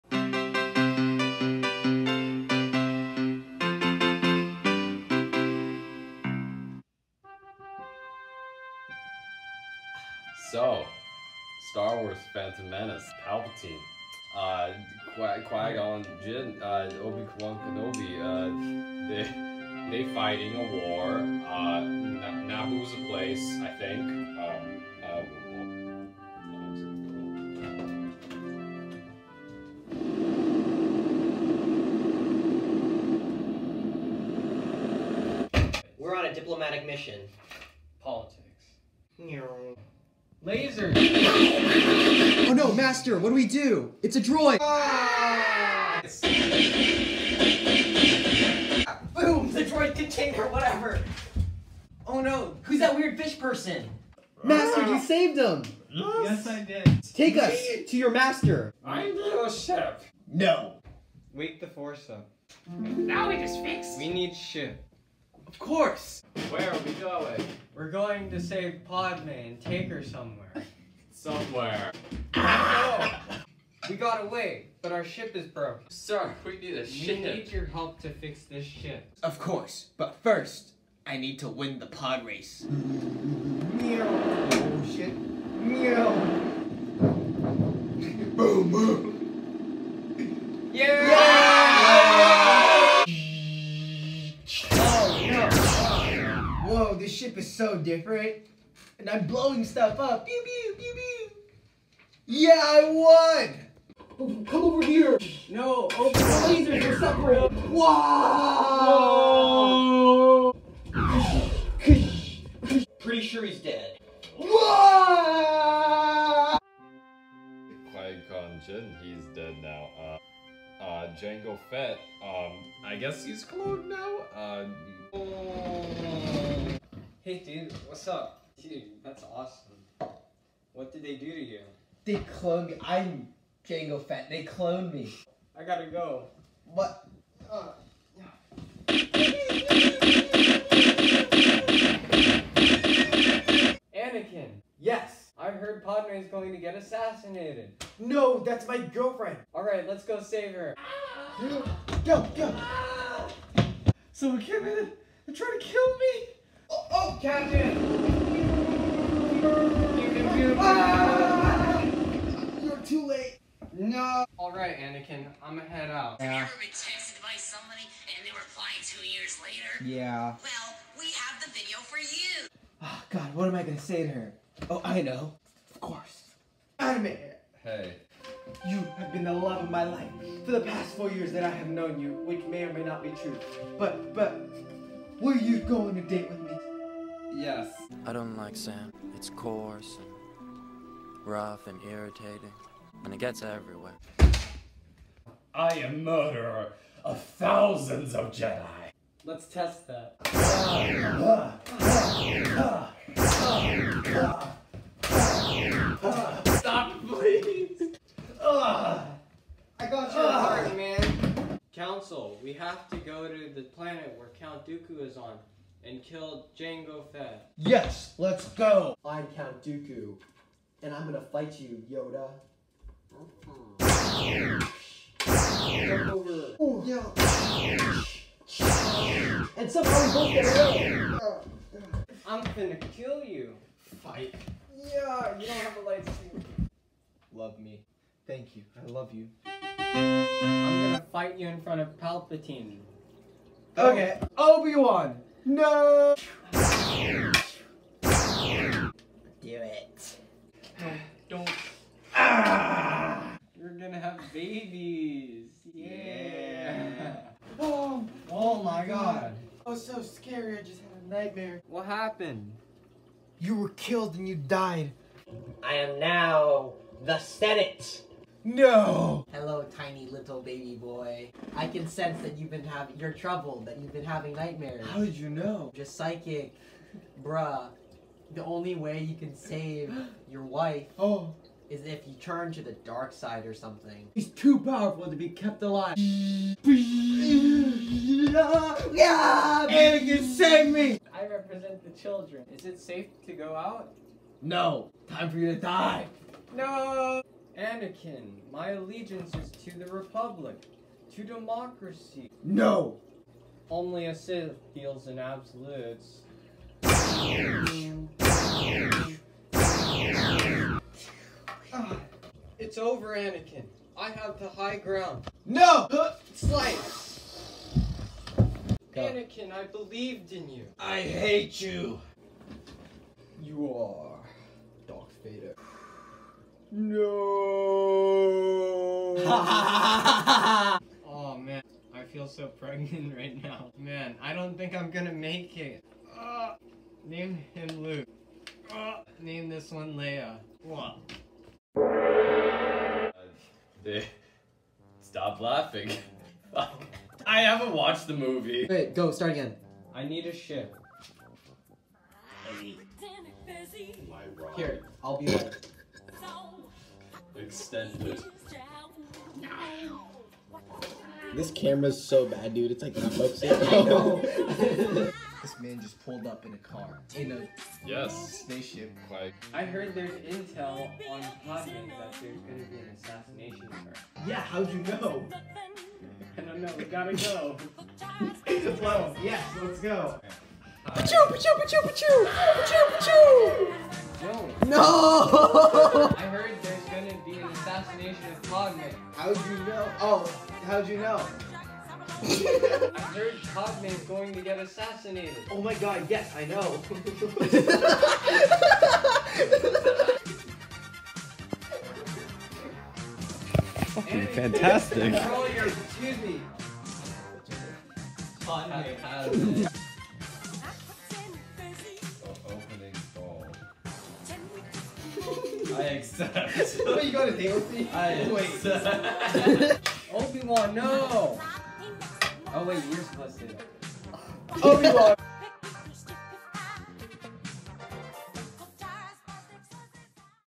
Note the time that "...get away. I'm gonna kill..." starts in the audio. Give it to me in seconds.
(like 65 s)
230 s.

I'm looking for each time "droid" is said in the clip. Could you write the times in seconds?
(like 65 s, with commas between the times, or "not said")
44 s, 49 s.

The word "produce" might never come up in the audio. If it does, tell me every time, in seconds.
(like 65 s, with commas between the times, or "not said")
not said.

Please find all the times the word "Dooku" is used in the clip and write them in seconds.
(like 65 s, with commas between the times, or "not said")
214 s, 219 s.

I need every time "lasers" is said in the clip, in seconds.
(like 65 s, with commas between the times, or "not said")
40 s, 106 s.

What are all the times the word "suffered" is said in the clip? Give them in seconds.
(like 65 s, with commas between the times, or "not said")
not said.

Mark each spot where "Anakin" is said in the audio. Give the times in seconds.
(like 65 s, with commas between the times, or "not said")
143 s, 164 s, 289 s, 297 s, 313 s, 319 s.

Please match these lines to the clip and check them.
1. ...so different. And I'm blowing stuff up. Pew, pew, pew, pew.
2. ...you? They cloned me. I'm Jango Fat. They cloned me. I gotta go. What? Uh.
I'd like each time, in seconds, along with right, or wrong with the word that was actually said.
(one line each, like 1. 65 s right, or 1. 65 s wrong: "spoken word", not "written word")
1. 97 s right
2. 131 s right.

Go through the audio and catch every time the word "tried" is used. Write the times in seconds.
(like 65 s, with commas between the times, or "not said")
155 s.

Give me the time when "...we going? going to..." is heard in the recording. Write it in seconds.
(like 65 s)
66 s.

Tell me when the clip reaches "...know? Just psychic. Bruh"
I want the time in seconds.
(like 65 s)
275 s.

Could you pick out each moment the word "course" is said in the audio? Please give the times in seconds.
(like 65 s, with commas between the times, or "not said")
65 s, 79 s, 175 s.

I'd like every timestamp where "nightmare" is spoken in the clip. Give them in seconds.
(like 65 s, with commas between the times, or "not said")
261 s, 274 s.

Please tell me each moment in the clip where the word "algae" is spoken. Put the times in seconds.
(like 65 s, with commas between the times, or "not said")
not said.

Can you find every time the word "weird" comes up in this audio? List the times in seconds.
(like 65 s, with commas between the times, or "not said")
52 s.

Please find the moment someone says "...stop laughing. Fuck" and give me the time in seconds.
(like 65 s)
345 s.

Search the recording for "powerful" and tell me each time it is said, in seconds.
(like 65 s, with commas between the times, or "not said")
284 s.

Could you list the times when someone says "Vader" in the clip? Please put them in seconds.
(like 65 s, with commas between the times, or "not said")
325 s.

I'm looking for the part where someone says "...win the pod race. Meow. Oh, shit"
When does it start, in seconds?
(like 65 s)
81 s.